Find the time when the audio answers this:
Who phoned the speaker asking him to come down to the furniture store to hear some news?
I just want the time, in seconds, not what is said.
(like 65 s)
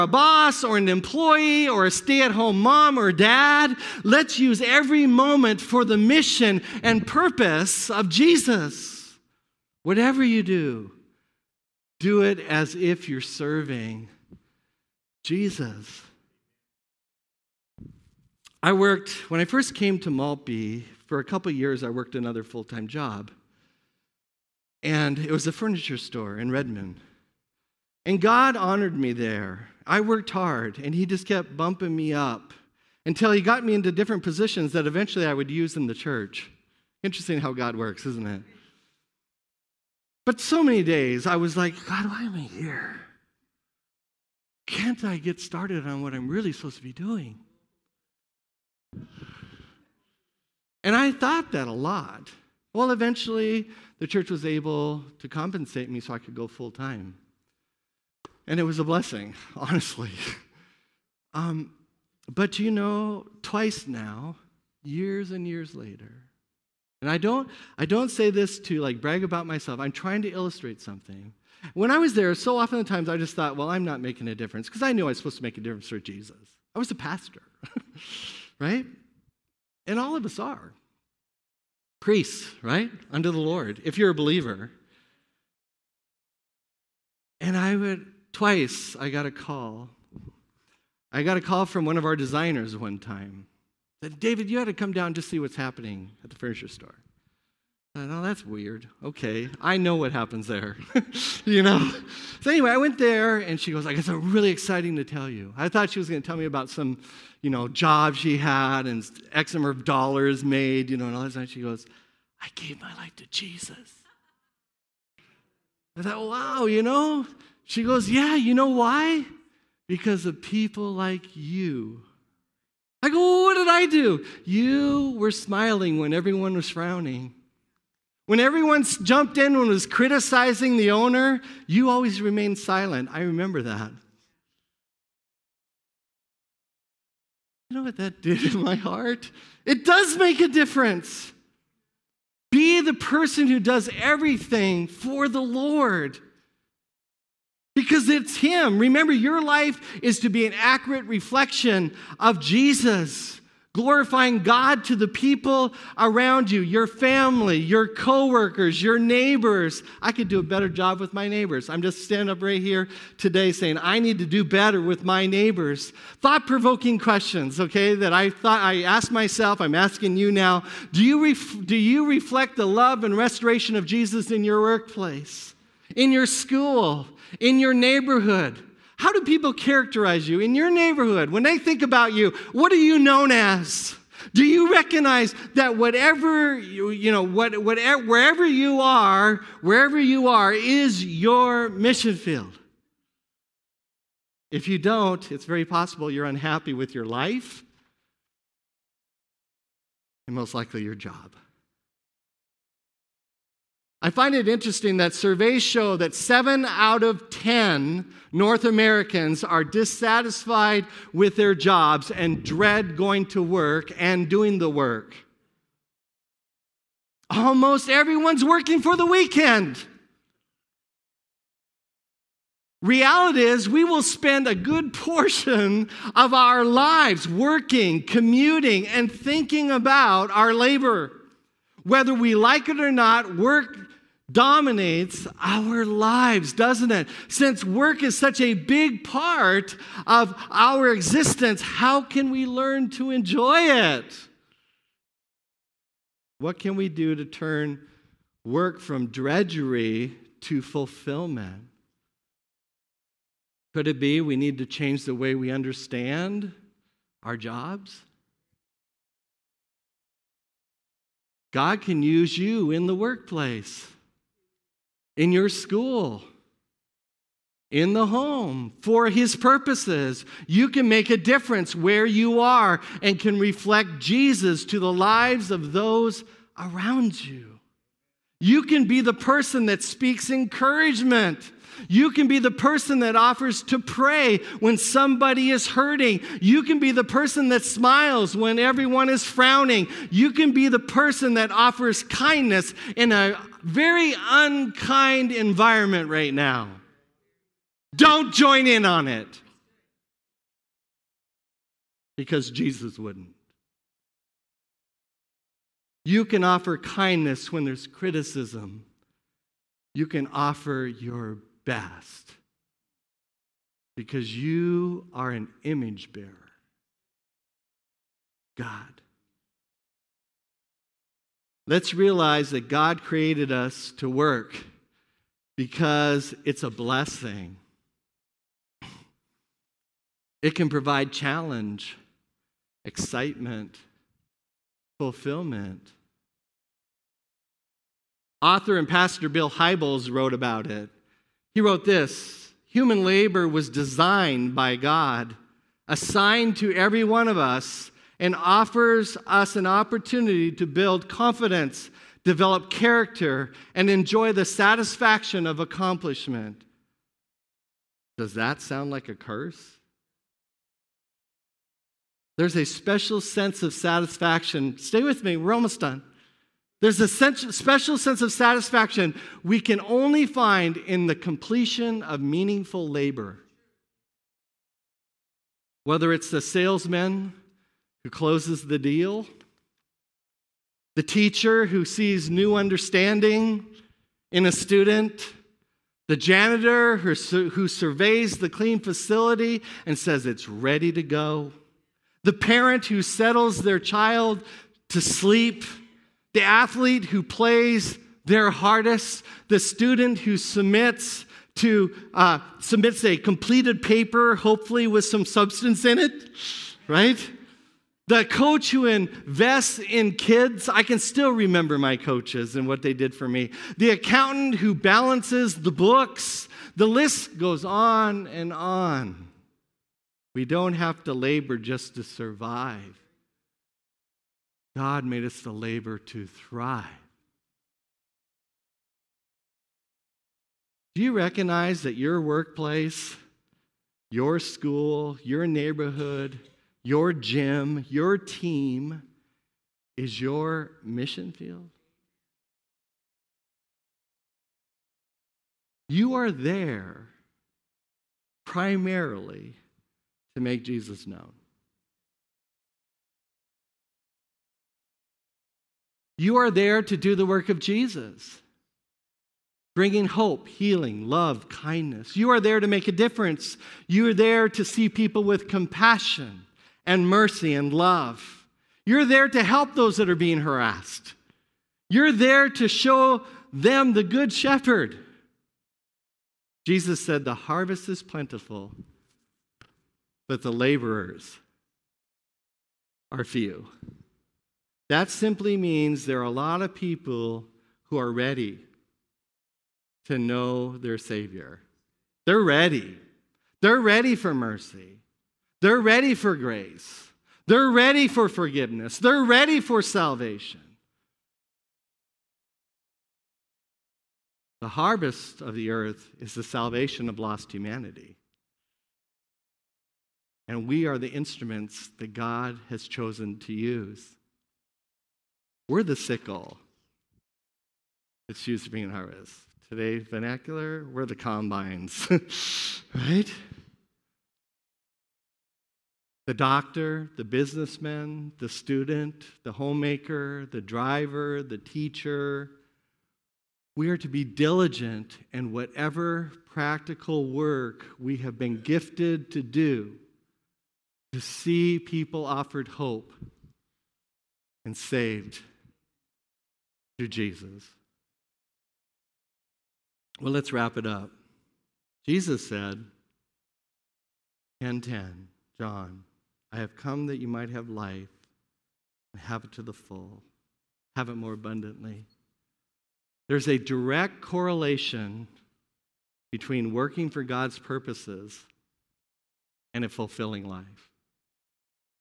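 91 s.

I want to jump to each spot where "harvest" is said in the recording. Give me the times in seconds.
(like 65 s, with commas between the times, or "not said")
477 s, 504 s, 518 s.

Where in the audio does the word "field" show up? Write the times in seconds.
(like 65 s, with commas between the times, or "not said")
192 s, 441 s.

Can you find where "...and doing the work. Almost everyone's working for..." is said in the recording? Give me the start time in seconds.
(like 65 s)
213 s.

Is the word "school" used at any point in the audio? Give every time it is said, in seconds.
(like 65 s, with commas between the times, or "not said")
176 s, 265 s, 434 s.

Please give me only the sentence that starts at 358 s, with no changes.
Does that sound like a curse?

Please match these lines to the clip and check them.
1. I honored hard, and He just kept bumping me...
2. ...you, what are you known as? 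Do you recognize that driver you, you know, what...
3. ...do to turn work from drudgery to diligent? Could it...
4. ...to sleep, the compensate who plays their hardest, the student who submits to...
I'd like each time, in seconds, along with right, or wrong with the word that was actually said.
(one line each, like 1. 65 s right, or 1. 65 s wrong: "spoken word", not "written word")
1. 29 s wrong: "worked", not "honored"
2. 182 s wrong: "whatever", not "driver"
3. 246 s wrong: "fulfillment", not "diligent"
4. 394 s wrong: "athlete", not "compensate".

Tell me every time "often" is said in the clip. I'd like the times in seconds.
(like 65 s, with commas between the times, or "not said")
72 s.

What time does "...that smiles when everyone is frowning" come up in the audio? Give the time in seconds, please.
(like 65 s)
287 s.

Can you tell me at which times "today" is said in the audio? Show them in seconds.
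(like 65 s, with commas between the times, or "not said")
163 s, 519 s.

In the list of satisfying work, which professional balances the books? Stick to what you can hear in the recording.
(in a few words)
The accountant.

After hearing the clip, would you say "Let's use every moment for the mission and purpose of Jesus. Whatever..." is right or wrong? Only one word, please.
right.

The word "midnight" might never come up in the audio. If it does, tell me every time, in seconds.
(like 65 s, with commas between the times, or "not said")
not said.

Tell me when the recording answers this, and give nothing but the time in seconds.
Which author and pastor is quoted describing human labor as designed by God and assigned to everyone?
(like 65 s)
339 s.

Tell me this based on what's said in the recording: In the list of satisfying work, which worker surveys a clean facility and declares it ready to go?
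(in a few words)
The janitor.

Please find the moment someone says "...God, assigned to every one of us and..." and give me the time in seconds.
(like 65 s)
344 s.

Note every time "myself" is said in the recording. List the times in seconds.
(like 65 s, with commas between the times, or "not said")
69 s, 169 s.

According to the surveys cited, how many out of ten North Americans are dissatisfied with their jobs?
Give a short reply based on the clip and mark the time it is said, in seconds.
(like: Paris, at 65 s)
7, at 206 s.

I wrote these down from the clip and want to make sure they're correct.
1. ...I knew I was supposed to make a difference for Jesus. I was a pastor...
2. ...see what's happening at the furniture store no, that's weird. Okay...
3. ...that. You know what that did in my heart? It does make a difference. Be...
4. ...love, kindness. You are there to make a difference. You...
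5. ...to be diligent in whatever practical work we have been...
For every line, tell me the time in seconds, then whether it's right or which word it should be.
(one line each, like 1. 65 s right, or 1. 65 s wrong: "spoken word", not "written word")
1. 74 s right
2. 95 s right
3. 133 s right
4. 461 s right
5. 533 s right.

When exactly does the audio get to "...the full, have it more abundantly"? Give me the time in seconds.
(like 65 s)
559 s.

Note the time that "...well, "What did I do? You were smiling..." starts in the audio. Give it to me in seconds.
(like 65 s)
123 s.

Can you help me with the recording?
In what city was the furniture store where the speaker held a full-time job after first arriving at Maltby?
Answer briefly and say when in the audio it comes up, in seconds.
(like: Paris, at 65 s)
Redmond, at 26 s.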